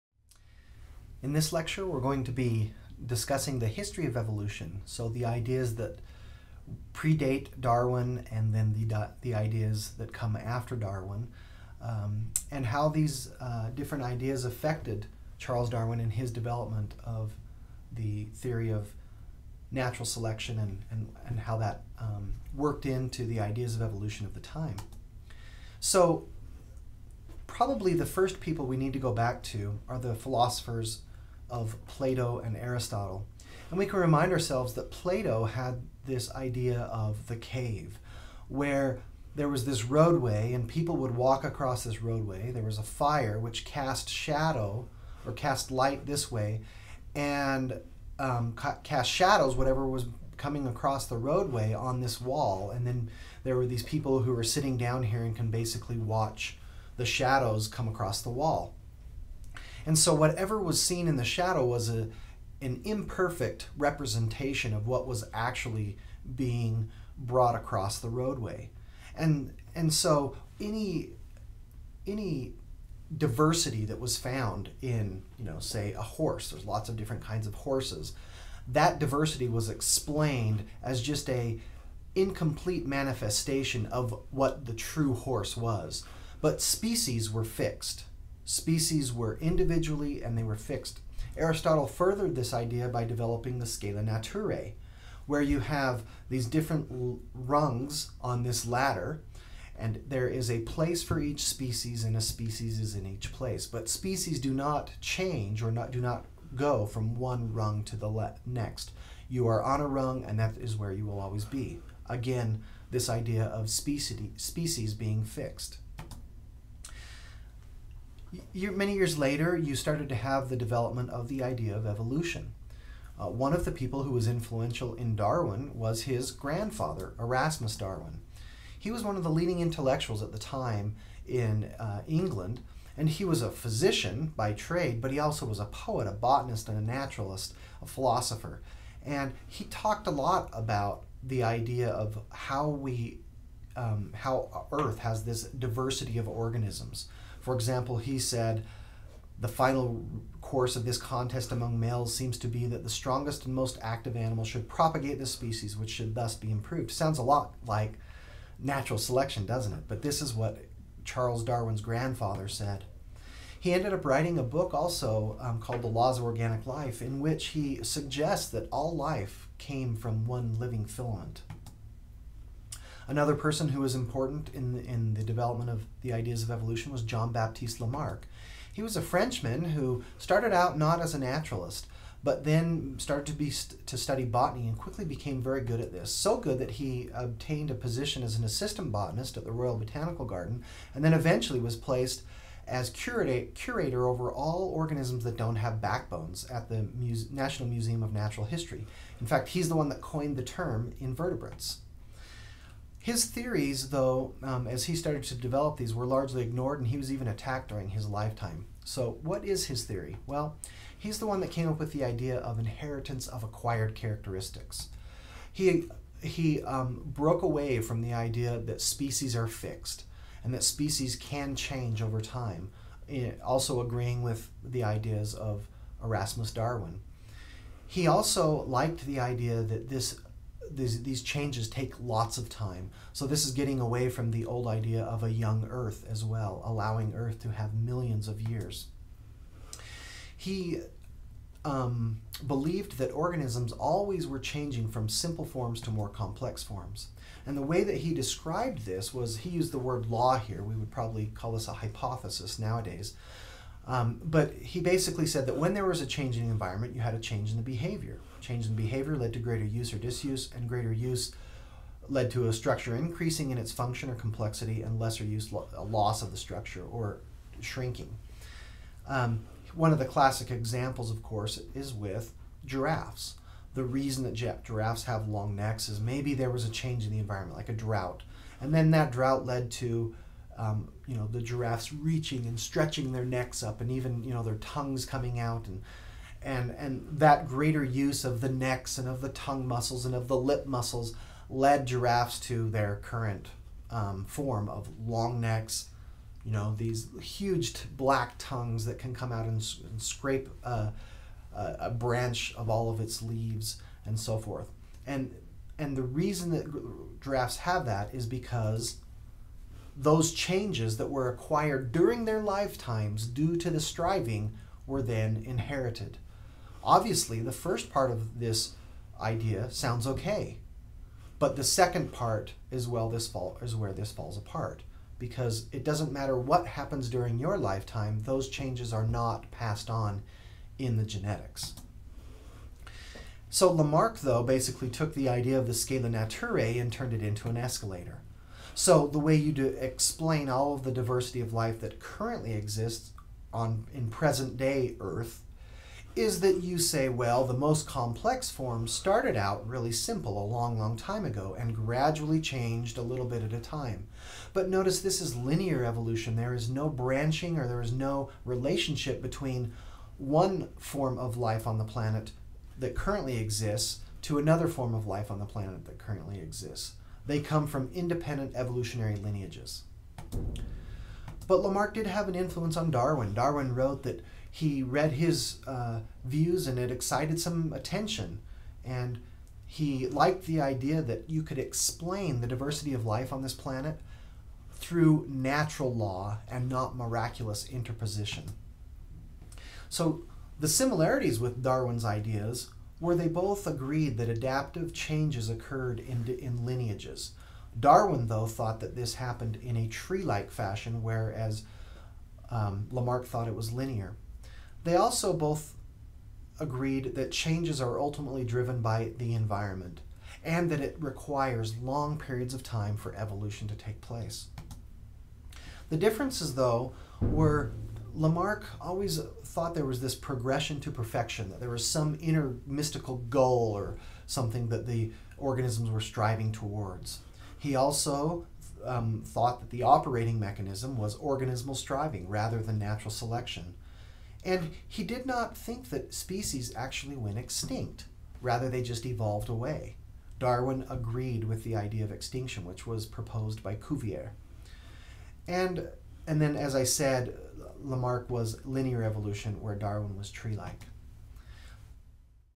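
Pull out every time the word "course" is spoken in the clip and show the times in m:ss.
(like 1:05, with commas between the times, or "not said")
2:30, 4:31.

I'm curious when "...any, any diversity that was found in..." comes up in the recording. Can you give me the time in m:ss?
1:10.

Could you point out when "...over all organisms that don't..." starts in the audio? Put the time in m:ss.
3:14.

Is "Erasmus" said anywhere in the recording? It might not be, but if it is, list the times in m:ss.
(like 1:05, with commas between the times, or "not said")
2:07, 3:46.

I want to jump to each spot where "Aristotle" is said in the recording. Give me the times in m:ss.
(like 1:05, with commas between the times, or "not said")
0:32, 1:31.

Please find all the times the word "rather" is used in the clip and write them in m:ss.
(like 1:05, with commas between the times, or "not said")
7:12, 7:18.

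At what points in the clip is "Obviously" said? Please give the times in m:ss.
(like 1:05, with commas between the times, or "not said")
5:16.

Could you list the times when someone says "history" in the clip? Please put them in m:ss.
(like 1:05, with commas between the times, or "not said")
0:03, 3:18.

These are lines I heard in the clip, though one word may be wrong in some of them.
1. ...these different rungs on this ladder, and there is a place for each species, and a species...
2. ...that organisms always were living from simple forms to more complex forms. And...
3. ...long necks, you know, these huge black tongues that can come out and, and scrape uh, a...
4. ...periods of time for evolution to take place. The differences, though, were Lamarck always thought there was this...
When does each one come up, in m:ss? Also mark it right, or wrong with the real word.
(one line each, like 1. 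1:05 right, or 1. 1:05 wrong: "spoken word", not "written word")
1. 1:36 right
2. 4:02 wrong: "changing", not "living"
3. 4:55 right
4. 6:52 right.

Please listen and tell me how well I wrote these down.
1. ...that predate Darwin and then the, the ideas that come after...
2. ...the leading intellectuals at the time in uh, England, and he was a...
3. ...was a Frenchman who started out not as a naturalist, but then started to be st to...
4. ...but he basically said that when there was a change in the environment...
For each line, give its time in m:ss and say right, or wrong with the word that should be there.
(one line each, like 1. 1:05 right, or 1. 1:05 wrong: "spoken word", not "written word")
1. 0:05 right
2. 2:09 right
3. 2:58 right
4. 4:14 right.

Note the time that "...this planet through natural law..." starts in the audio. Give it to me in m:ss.
6:23.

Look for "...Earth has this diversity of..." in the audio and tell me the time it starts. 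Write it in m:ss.
2:24.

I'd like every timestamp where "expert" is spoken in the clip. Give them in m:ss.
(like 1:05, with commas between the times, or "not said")
not said.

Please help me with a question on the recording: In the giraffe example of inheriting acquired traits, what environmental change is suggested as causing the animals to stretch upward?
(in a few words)
a drought.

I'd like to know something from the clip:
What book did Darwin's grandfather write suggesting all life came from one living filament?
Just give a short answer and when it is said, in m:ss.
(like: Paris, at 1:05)
The Laws of Organic Life, at 2:45.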